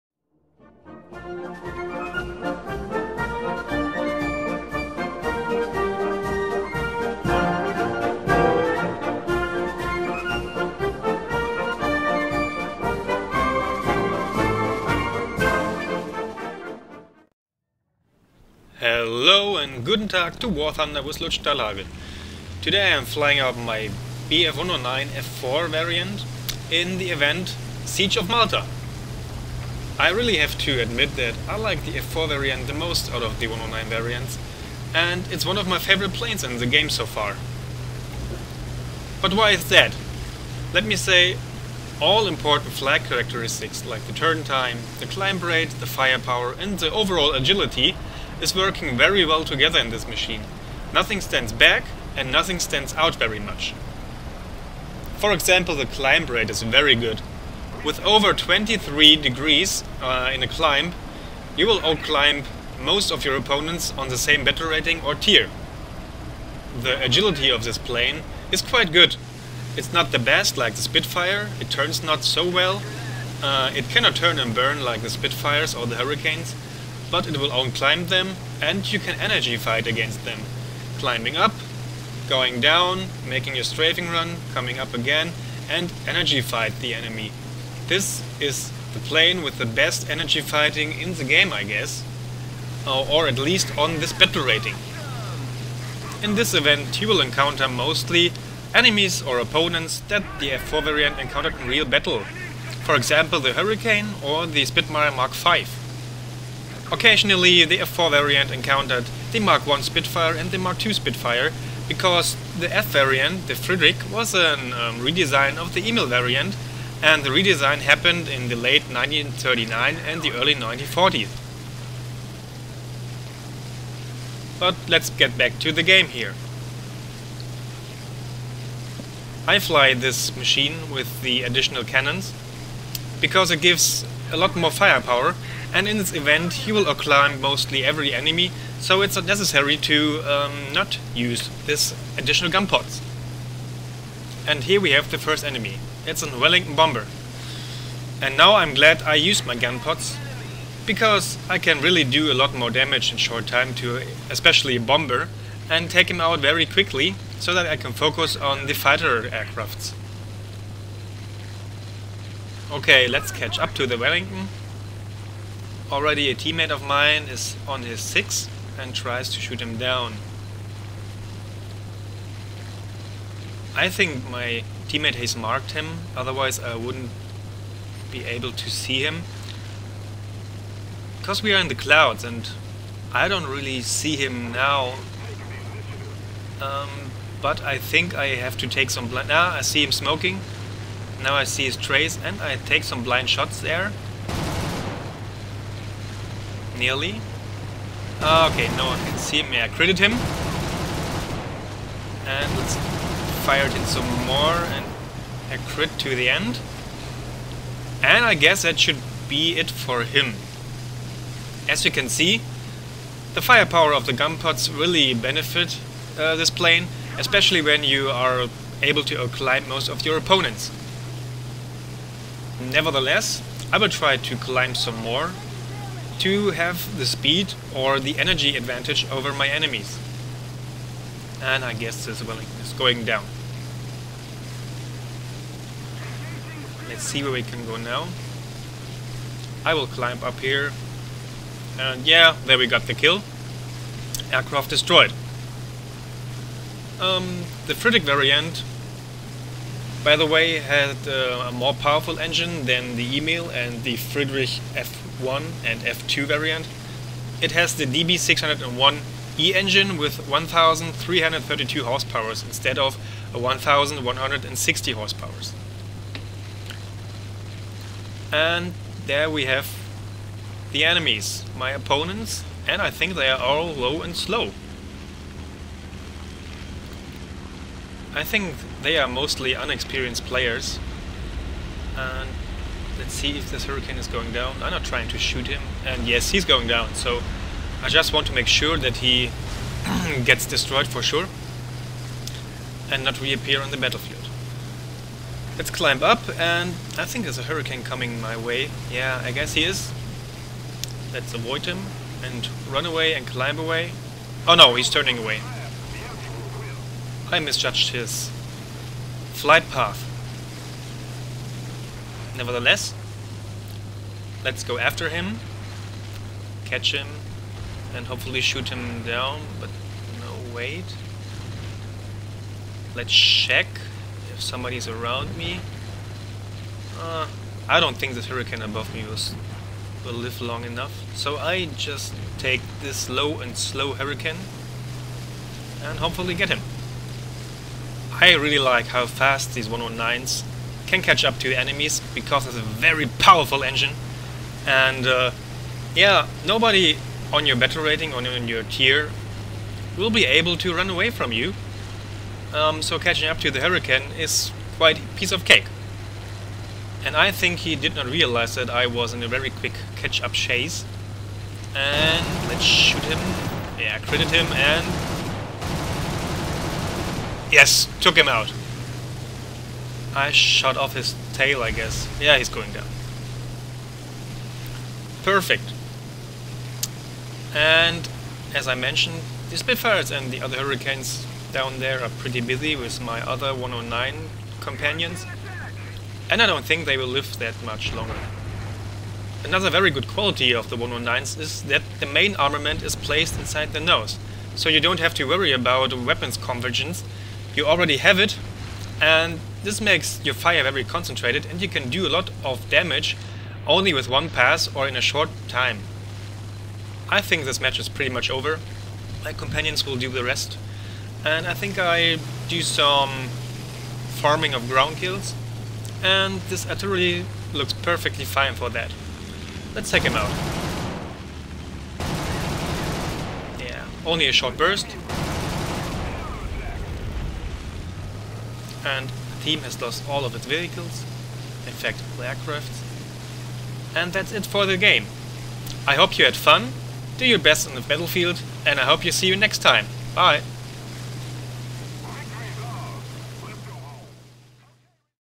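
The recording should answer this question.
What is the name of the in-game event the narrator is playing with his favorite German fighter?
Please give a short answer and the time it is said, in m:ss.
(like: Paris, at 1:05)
Siege of Malta, at 0:27.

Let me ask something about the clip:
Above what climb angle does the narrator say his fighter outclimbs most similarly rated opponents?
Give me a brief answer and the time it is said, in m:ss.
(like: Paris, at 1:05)
23, at 0:58.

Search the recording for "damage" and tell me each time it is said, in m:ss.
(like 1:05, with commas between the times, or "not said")
2:32, 6:42.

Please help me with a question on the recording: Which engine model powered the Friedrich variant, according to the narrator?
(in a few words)
DB601E.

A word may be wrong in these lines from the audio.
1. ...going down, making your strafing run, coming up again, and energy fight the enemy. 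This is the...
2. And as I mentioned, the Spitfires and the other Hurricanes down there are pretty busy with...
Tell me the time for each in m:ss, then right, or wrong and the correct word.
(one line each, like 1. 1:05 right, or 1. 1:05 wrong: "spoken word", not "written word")
1. 1:22 right
2. 6:17 right.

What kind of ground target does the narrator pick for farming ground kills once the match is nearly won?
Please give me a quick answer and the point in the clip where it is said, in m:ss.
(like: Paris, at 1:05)
artillery, at 6:56.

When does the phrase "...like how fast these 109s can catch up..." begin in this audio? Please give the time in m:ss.
5:38.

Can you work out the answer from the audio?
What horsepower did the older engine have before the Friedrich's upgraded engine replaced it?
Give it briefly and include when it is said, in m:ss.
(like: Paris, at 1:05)
1160, at 4:23.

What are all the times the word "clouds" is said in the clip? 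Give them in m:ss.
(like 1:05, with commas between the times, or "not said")
3:01.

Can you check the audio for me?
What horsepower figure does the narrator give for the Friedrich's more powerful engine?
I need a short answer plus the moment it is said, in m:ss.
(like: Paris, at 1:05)
1332, at 4:20.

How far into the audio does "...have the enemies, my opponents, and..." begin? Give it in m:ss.
4:29.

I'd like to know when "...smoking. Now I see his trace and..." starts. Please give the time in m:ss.
3:09.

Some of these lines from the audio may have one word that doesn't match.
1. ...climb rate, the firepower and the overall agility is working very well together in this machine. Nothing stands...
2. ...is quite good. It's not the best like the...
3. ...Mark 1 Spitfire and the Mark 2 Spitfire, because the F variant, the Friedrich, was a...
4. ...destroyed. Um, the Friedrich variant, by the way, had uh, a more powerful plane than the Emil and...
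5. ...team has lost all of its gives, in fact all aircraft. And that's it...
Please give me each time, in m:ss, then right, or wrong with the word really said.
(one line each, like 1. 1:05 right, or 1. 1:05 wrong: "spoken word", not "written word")
1. 0:45 right
2. 1:08 right
3. 1:49 right
4. 4:04 wrong: "engine", not "plane"
5. 7:09 wrong: "vehicles", not "gives".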